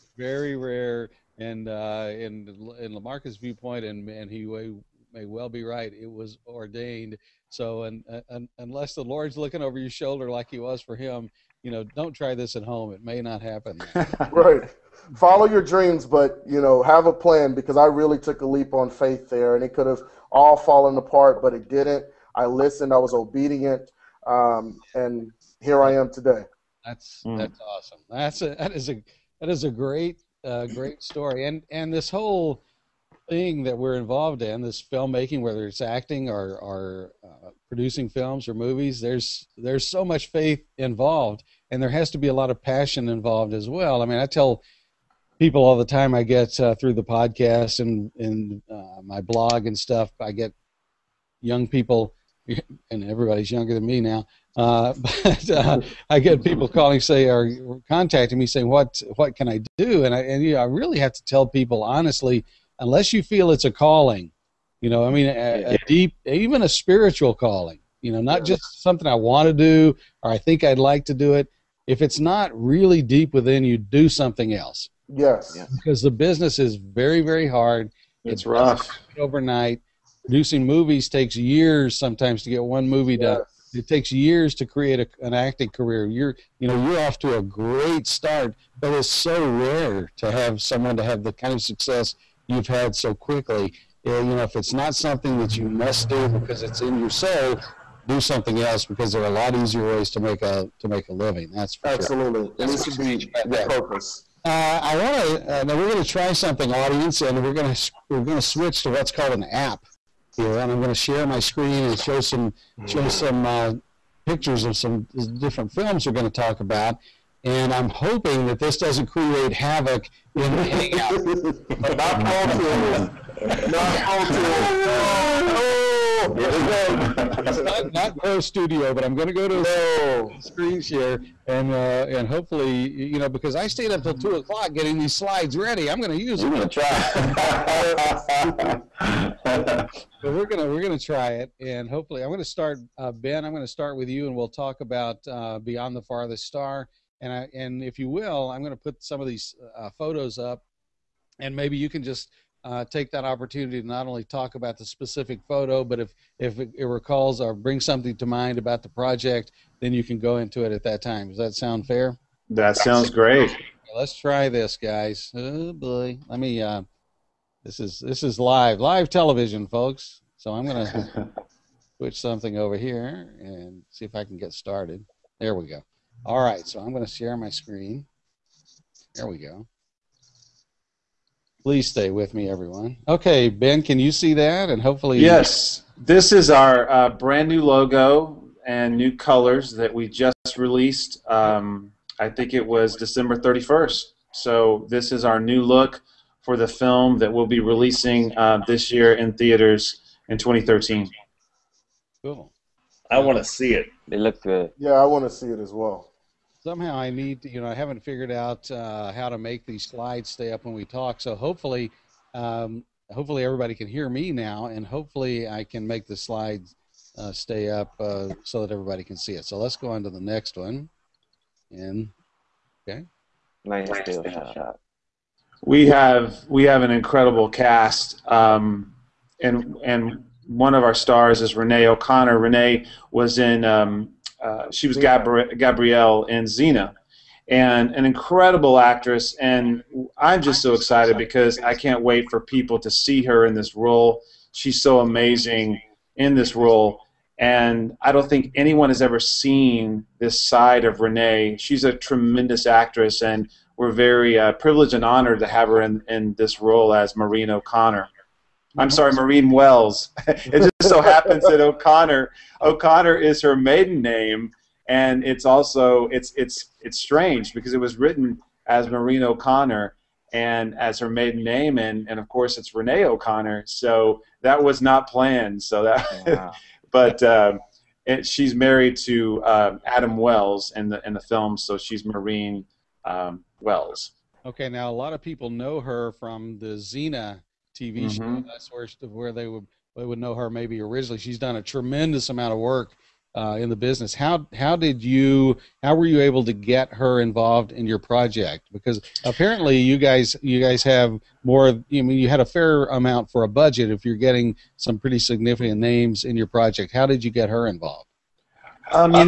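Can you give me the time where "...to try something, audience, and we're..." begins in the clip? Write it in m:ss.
1:46.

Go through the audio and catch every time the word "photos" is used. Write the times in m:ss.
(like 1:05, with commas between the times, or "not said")
2:29, 2:35.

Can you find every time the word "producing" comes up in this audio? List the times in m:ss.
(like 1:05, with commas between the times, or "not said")
0:37, 1:20.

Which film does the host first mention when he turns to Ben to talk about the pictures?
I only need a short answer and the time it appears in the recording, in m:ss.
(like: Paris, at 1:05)
Beyond the Farthest Star, at 2:25.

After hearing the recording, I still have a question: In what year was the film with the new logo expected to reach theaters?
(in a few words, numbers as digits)
2013.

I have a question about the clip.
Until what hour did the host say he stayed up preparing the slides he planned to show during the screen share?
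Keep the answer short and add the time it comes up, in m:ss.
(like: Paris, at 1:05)
2 o'clock, at 2:14.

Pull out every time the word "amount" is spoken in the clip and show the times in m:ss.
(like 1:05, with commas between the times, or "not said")
4:52, 5:02.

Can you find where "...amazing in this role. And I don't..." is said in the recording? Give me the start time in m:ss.
4:04.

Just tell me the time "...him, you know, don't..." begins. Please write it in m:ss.
0:10.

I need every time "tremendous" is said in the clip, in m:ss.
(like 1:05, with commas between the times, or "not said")
4:11, 4:51.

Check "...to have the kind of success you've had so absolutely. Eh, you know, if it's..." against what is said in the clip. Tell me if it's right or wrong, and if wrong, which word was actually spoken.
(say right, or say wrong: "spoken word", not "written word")
wrong: "quickly", not "absolutely".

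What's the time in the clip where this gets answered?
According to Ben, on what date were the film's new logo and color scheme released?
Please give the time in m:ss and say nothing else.
3:12.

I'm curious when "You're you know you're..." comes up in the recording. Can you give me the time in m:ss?
1:26.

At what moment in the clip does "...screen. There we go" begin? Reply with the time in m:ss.
2:57.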